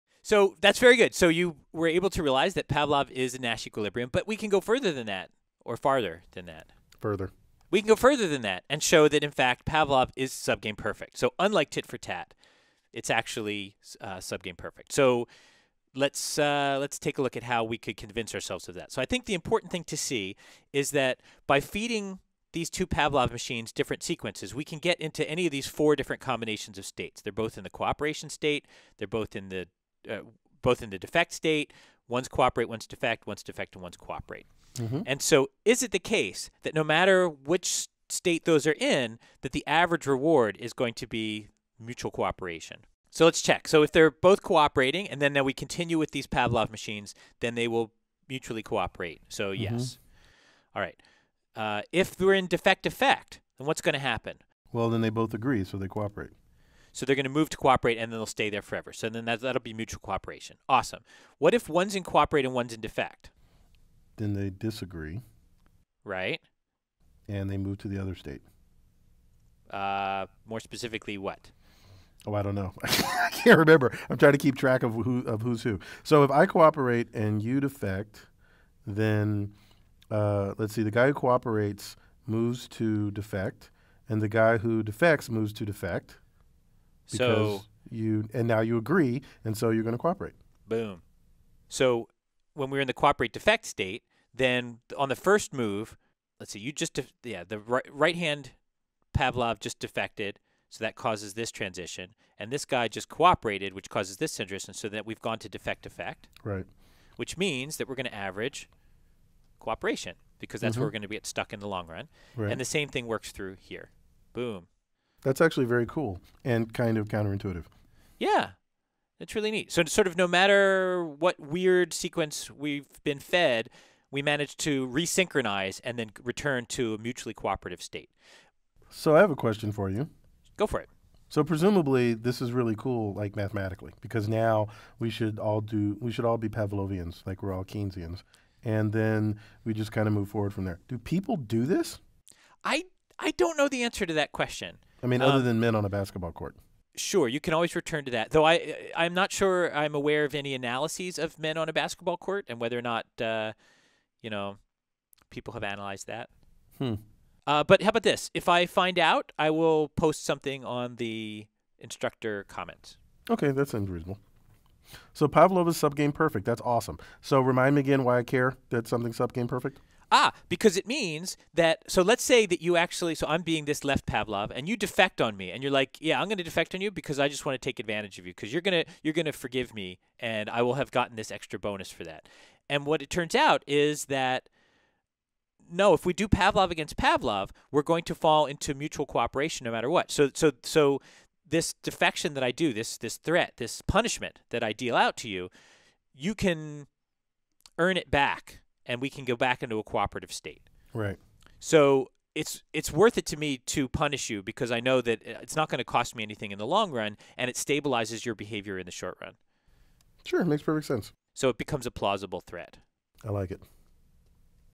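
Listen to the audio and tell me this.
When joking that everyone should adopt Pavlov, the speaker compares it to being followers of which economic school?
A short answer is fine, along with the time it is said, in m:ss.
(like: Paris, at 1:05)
Keynesians, at 2:17.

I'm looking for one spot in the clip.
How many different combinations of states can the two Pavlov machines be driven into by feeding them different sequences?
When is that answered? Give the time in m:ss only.
0:25.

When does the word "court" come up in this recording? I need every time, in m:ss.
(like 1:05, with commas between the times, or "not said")
2:26, 2:32.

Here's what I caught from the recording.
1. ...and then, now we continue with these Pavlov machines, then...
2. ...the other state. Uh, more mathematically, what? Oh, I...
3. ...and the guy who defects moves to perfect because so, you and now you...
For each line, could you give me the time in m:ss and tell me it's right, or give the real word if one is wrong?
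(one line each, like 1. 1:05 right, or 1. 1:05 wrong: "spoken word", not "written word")
1. 0:45 right
2. 1:07 wrong: "specifically", not "mathematically"
3. 1:24 wrong: "defect", not "perfect".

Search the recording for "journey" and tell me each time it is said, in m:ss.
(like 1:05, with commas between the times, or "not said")
not said.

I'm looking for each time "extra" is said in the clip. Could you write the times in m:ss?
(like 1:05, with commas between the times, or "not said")
3:01.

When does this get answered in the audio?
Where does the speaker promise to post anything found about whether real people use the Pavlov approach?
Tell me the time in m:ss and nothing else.
2:41.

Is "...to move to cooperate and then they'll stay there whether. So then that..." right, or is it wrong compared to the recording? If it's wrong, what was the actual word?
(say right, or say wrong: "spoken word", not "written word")
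wrong: "forever", not "whether".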